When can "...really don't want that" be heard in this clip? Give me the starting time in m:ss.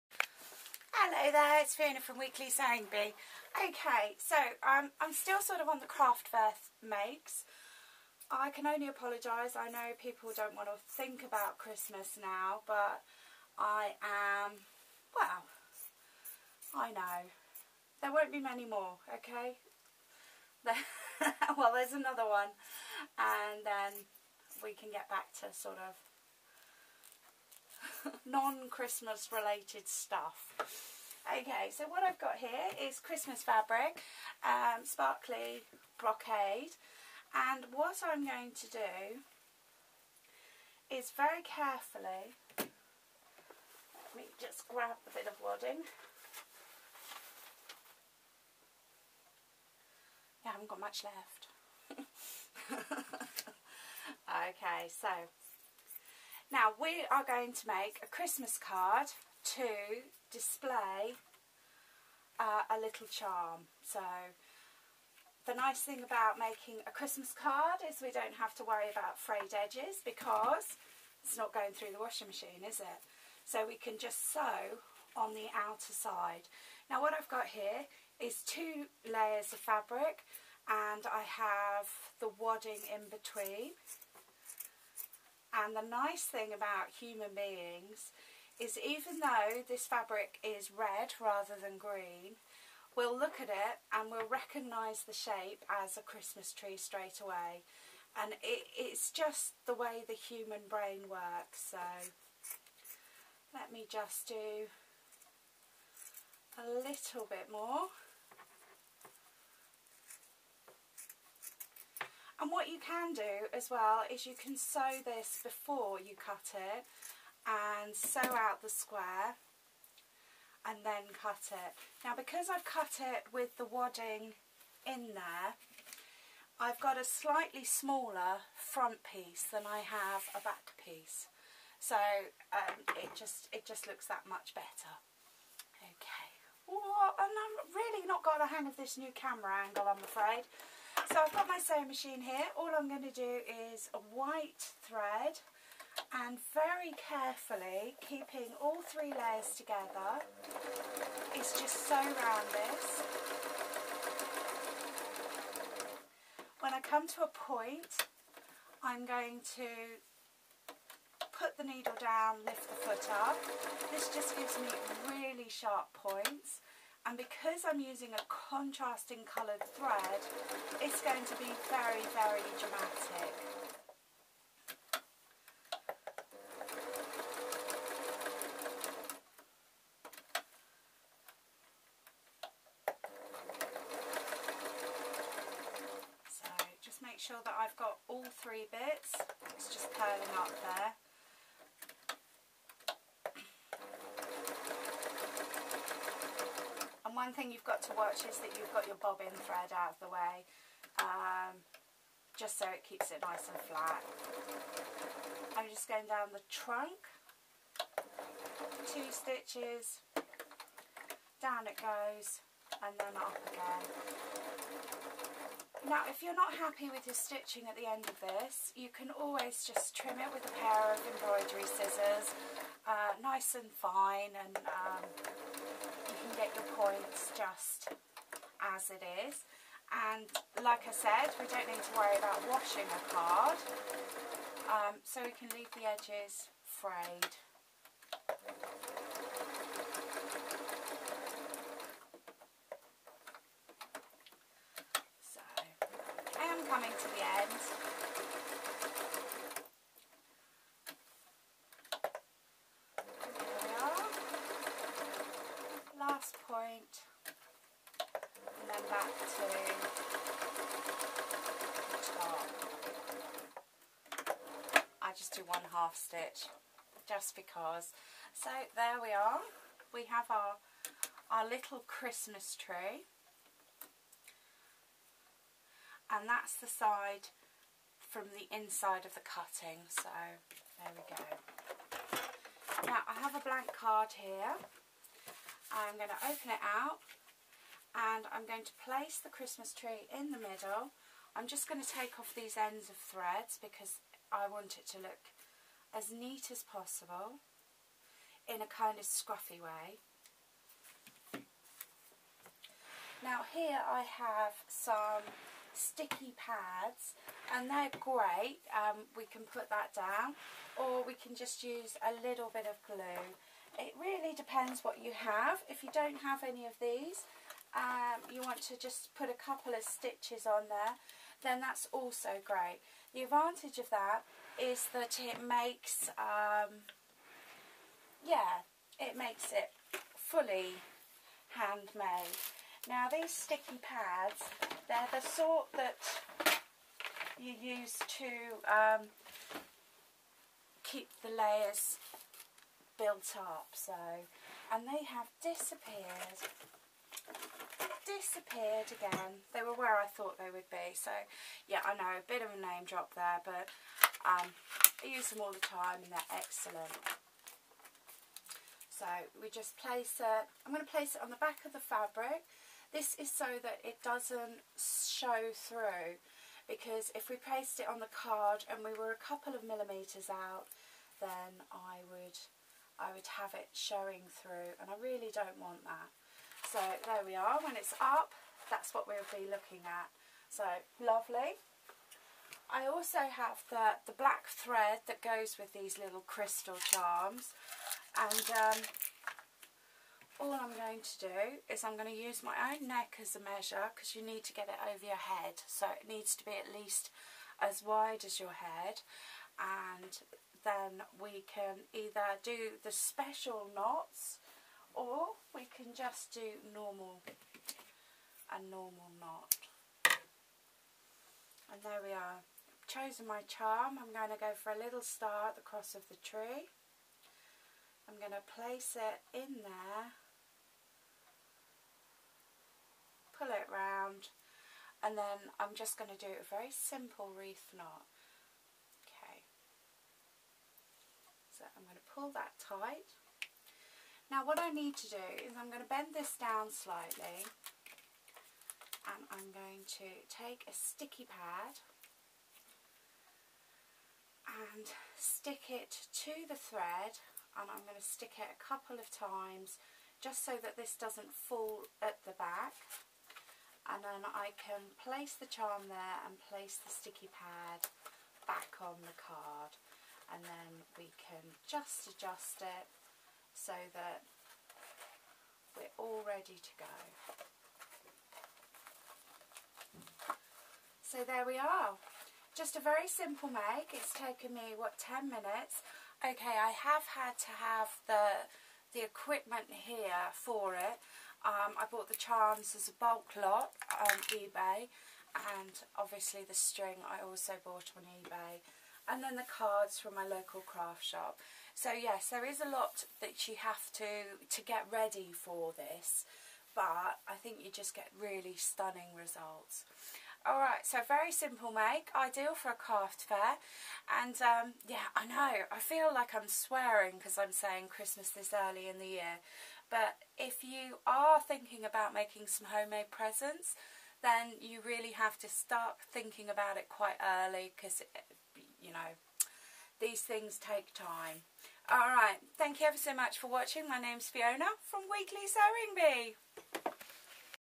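6:15.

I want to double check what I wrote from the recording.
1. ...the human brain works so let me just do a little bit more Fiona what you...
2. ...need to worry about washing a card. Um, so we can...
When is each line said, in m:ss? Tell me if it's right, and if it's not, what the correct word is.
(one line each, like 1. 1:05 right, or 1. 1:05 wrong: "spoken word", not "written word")
1. 1:40 wrong: "And", not "Fiona"
2. 3:51 right.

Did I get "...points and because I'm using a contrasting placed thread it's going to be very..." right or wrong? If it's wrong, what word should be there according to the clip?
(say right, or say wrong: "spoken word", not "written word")
wrong: "coloured", not "placed".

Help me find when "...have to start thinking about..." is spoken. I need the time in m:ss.
8:35.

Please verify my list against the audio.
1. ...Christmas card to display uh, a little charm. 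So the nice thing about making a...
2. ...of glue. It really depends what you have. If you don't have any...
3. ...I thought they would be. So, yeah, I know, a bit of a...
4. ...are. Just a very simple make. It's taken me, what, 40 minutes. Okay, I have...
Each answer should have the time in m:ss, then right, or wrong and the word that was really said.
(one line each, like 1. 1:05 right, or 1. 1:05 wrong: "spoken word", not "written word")
1. 0:58 right
2. 5:12 right
3. 5:49 right
4. 7:51 wrong: "10", not "40".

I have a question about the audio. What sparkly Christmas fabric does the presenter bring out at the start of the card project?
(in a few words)
sparkly brocade.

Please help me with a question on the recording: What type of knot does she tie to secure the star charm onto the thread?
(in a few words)
reef knot.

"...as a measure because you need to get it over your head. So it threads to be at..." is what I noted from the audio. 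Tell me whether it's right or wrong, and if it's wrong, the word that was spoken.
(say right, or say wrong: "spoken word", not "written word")
wrong: "needs", not "threads".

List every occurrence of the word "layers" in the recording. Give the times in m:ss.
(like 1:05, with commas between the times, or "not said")
1:19, 2:29, 5:41.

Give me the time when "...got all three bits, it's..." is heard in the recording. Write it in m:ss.
3:07.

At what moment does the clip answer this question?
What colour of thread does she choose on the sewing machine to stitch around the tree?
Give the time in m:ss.
2:23.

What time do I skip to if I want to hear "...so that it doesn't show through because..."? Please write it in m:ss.
6:03.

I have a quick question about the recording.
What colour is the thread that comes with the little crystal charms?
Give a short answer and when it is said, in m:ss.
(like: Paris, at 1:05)
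black, at 6:24.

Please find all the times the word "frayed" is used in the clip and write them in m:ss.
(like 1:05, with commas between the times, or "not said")
1:09, 3:56.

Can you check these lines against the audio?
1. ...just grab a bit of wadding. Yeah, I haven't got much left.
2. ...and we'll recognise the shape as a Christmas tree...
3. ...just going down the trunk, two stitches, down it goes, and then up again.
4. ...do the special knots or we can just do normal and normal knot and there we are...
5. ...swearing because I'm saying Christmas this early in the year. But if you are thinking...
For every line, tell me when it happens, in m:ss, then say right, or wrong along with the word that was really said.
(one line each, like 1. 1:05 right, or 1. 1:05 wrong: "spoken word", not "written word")
1. 0:44 right
2. 1:33 right
3. 3:25 right
4. 6:42 right
5. 8:26 right.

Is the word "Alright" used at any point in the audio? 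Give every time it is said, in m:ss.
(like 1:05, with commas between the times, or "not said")
8:20, 8:41.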